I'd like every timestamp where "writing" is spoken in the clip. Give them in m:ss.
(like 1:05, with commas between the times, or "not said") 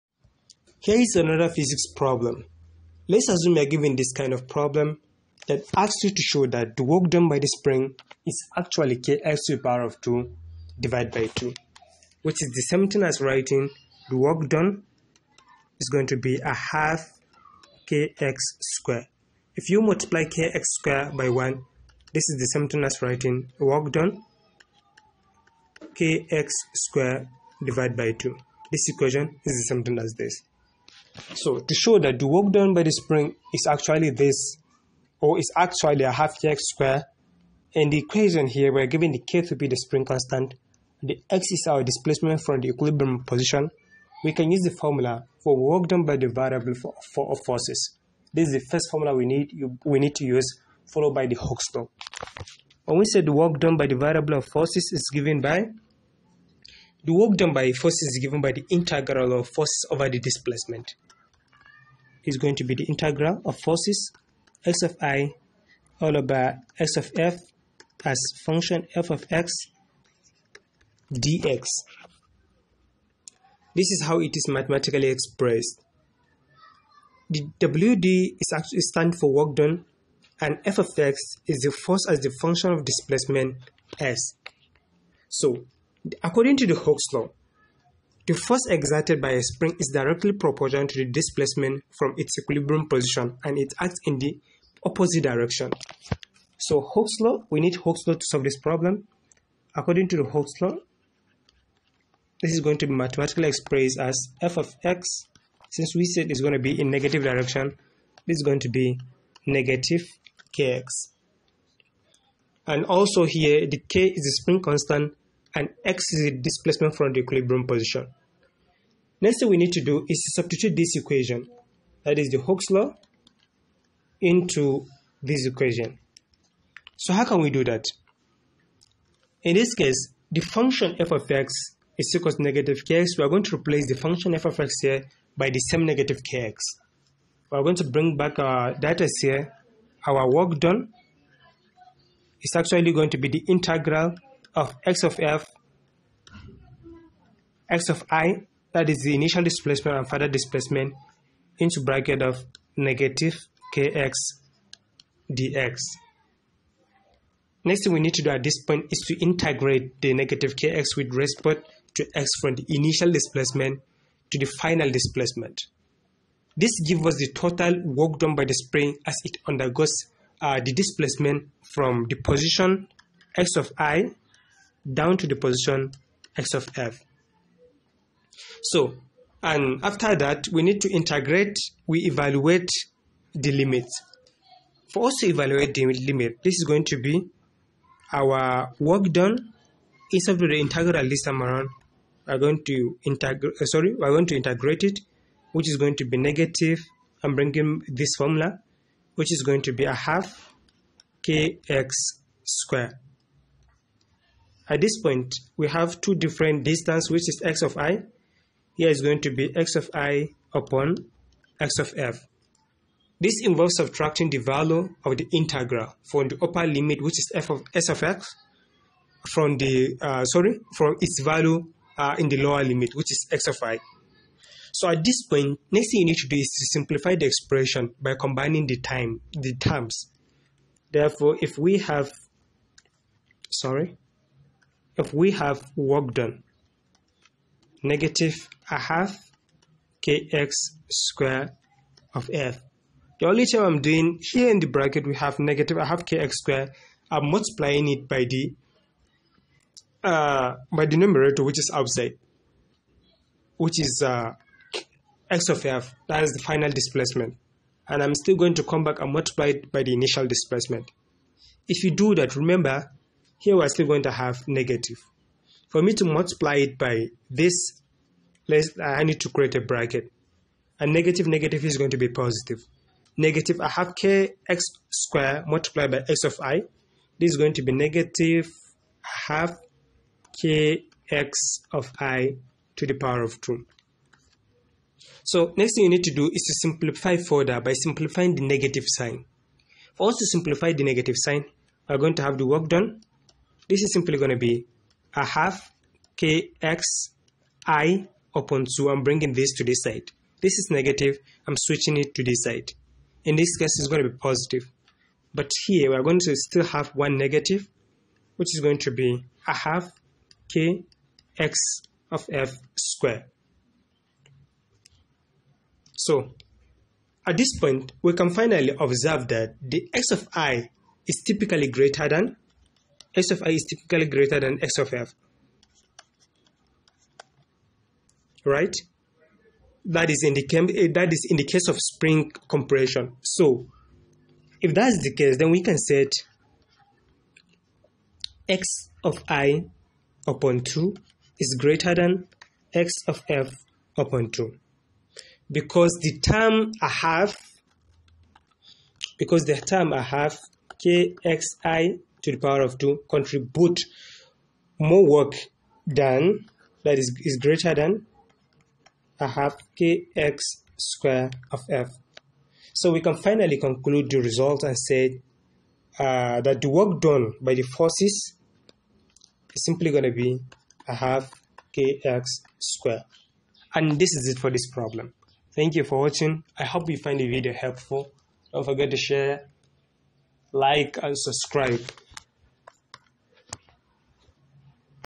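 0:13, 0:23.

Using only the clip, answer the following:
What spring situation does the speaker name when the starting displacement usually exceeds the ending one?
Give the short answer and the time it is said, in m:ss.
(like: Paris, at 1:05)
spring compression, at 5:31.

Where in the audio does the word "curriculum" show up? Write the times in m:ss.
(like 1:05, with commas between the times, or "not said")
not said.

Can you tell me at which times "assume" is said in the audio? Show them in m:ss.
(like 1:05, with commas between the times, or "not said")
0:03.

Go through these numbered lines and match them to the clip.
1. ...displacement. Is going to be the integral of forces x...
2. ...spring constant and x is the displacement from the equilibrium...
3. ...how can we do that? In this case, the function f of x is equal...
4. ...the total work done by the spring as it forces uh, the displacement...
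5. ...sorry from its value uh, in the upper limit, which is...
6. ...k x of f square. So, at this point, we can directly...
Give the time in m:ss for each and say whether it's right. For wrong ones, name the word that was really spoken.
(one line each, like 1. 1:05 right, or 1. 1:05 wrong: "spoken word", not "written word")
1. 1:00 right
2. 1:54 right
3. 2:07 right
4. 2:47 wrong: "undergoes", not "forces"
5. 3:40 wrong: "lower", not "upper"
6. 5:10 wrong: "finally", not "directly".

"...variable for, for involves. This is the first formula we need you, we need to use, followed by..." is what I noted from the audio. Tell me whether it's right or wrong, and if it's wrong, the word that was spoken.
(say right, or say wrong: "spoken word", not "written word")
wrong: "forces", not "involves".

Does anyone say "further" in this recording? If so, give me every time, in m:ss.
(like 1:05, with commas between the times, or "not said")
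2:30, 4:47.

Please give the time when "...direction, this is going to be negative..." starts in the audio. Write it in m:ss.
1:47.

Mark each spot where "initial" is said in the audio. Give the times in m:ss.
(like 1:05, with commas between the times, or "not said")
2:29, 2:42, 4:19.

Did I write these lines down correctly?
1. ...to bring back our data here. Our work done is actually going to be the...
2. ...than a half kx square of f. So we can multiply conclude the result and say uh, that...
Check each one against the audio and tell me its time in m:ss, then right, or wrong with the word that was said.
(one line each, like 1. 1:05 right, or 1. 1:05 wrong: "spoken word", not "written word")
1. 2:17 right
2. 5:57 wrong: "finally", not "multiply".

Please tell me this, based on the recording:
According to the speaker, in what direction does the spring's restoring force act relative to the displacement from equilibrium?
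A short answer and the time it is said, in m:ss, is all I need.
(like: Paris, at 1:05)
opposite direction, at 1:34.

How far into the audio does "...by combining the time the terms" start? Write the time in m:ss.
3:48.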